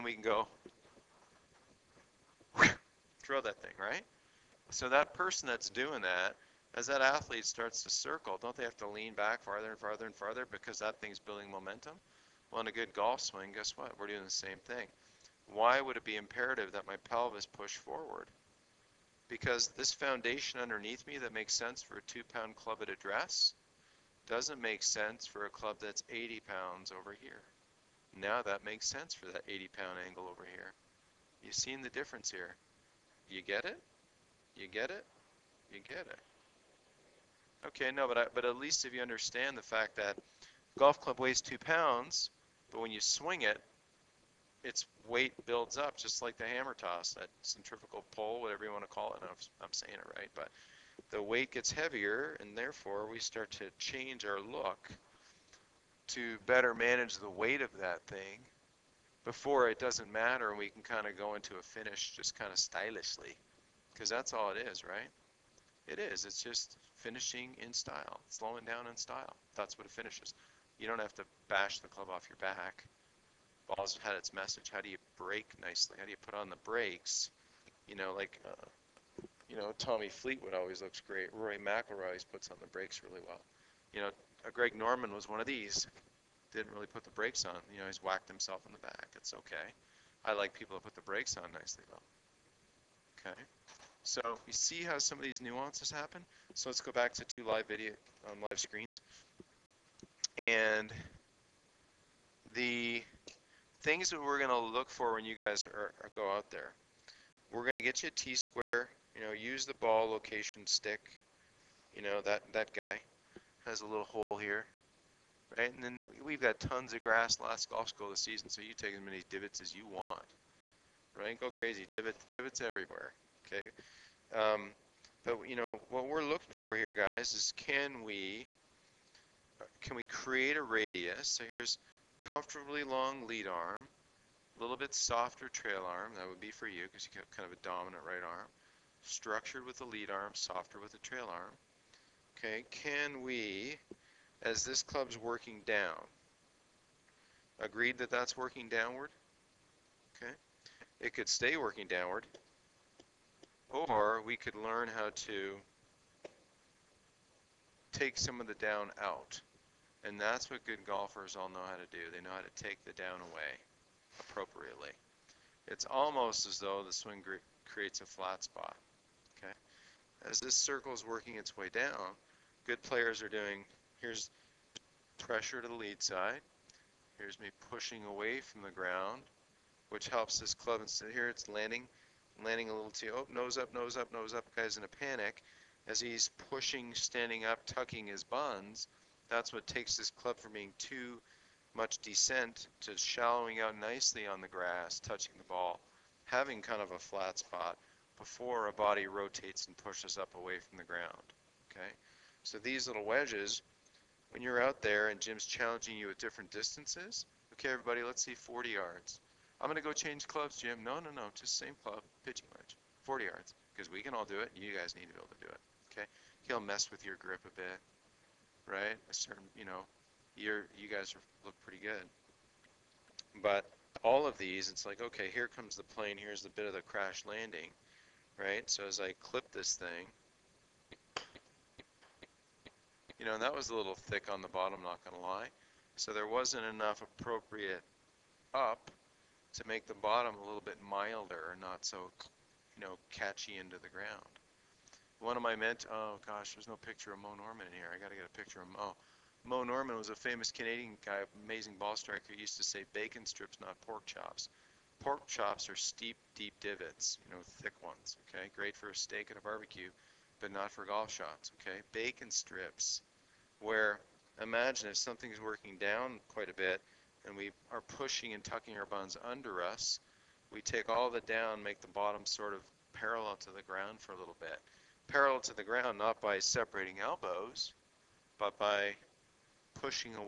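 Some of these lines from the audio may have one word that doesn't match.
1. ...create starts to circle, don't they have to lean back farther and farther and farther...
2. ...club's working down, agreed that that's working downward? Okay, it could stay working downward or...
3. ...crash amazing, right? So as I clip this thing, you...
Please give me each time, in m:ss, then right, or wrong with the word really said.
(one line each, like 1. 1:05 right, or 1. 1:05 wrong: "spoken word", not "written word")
1. 0:07 wrong: "athlete", not "create"
2. 2:24 right
3. 3:46 wrong: "landing", not "amazing".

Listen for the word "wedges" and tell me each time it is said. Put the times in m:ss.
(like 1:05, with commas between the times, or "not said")
3:23, 3:32.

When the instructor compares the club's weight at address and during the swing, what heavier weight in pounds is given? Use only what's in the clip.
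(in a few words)
80.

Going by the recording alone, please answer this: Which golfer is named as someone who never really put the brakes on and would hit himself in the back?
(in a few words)
Greg Norman.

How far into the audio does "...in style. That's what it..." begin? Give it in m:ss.
1:08.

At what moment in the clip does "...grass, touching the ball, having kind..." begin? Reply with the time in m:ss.
3:14.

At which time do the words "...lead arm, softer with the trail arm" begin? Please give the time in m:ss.
2:19.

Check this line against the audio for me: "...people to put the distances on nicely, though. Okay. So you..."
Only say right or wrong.
wrong.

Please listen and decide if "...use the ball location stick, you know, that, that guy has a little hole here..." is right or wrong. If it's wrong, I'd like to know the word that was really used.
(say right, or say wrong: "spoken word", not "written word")
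right.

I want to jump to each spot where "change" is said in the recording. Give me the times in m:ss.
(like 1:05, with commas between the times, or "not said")
0:53, 3:29.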